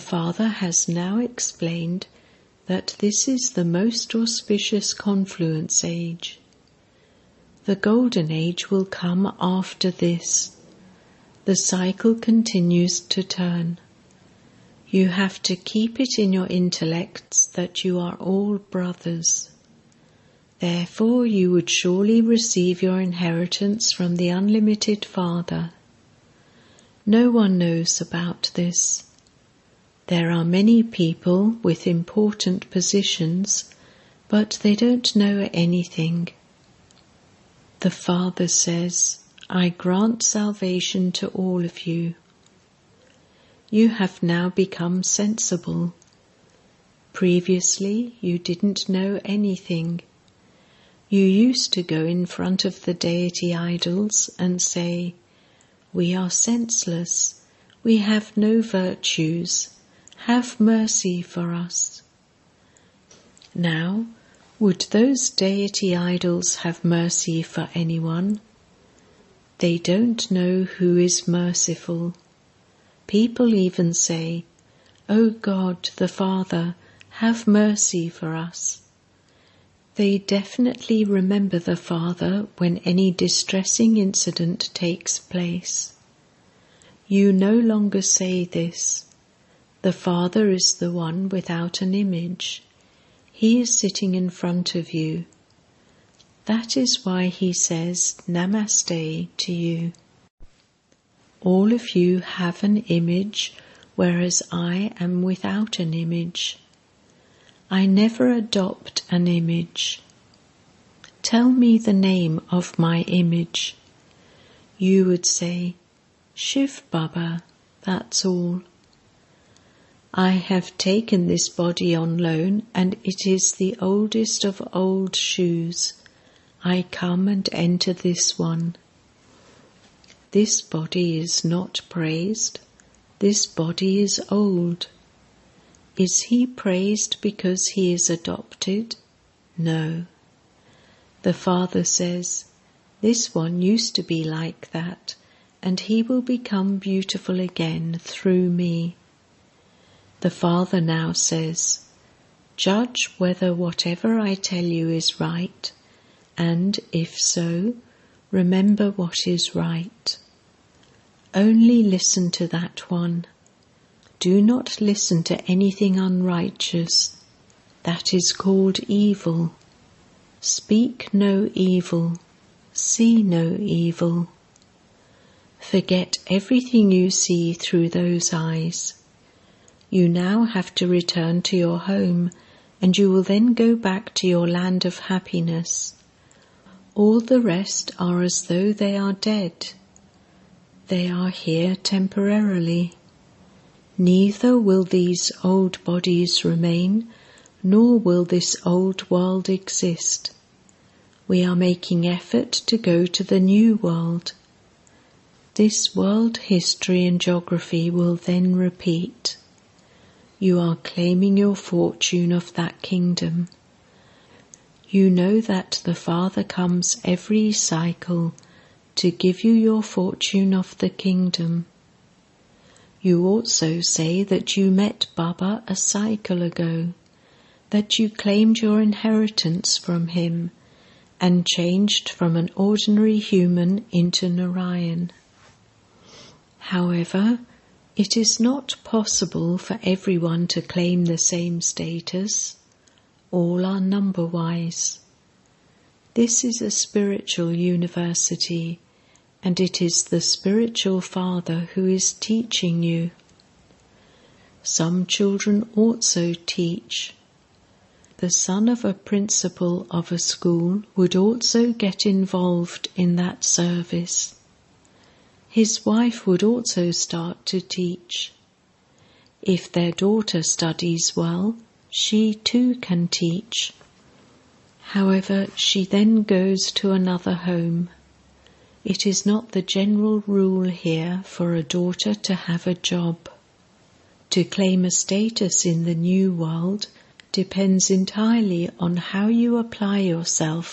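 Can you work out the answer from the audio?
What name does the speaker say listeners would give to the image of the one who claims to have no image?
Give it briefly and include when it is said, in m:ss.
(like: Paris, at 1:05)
Shiv Baba, at 1:56.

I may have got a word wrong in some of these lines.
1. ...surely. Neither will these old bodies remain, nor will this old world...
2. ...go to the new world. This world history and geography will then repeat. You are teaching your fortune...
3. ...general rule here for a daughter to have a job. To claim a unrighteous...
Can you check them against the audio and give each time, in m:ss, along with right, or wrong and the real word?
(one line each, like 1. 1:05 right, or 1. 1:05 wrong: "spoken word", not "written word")
1. 3:11 wrong: "temporarily", not "surely"
2. 3:22 wrong: "claiming", not "teaching"
3. 4:39 wrong: "status", not "unrighteous".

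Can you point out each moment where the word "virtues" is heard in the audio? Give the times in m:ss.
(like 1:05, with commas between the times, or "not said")
0:58.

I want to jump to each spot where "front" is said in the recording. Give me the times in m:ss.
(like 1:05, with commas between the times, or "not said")
0:52, 1:34.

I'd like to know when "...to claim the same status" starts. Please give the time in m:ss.
4:00.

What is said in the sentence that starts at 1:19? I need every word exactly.
They definitely remember the Father when any distressing incident takes place.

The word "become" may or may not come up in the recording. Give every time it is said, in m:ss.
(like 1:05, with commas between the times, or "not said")
0:44, 2:26.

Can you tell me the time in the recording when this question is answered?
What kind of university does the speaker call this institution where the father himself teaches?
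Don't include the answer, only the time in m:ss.
4:06.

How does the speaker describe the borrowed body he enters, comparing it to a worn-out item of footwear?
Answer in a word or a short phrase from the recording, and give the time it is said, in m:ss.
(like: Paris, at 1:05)
oldest of old shoes, at 2:03.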